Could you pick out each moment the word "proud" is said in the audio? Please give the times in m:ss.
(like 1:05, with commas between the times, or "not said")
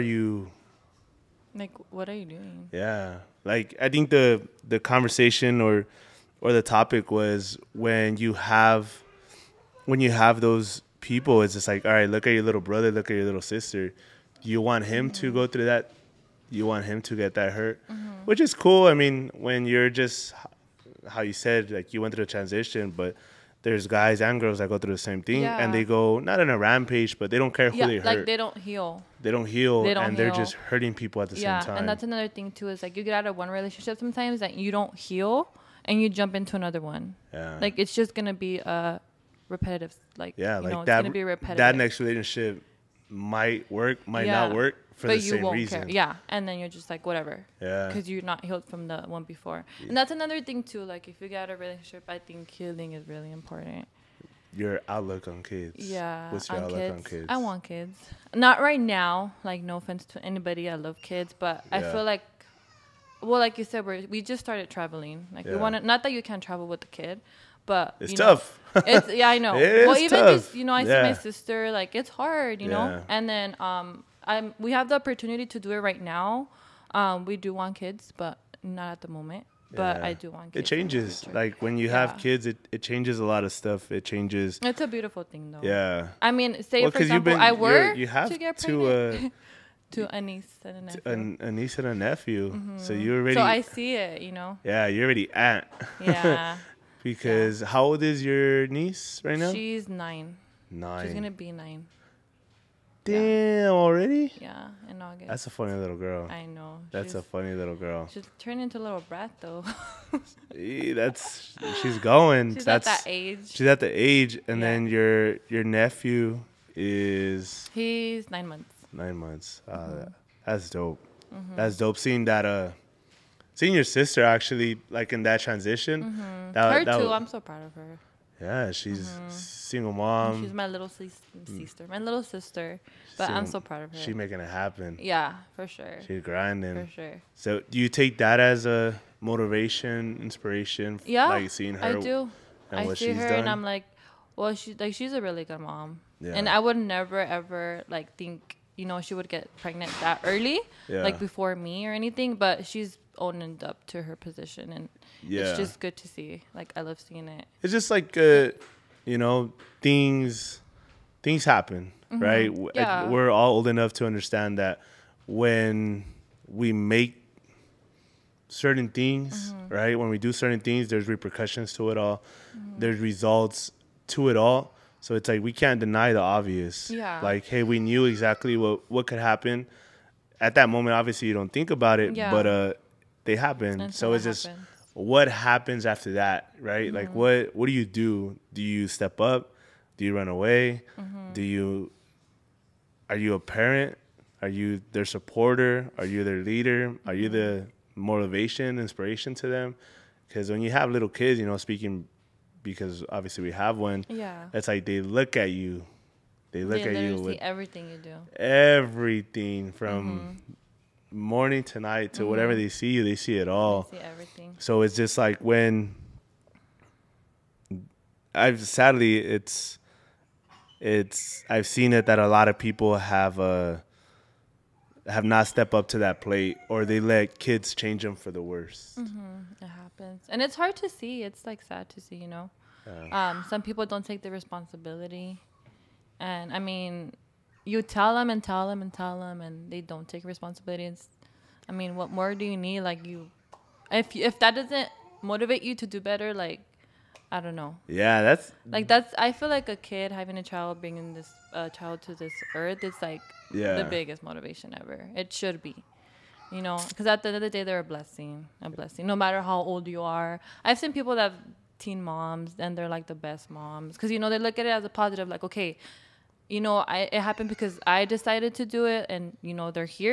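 2:07, 2:13.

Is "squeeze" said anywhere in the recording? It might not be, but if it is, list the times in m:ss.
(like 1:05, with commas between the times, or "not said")
not said.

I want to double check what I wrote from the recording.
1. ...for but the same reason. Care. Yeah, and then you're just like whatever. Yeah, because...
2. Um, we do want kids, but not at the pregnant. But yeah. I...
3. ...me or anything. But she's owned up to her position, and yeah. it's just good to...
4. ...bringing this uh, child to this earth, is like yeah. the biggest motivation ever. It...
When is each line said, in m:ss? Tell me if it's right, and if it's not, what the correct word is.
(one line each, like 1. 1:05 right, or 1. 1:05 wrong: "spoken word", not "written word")
1. 0:44 right
2. 1:16 wrong: "moment", not "pregnant"
3. 2:31 right
4. 4:10 right.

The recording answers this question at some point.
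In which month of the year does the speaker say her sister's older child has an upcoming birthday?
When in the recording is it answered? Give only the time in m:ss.
1:45.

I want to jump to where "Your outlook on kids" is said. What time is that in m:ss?
0:54.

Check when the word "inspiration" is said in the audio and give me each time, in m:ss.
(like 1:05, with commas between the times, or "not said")
2:20, 3:18.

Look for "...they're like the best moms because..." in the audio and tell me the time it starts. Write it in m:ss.
4:22.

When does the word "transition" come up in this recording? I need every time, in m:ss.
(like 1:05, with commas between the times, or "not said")
0:22, 2:05.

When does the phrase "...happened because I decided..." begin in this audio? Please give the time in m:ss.
4:27.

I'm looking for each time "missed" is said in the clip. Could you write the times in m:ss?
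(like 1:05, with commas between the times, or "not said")
not said.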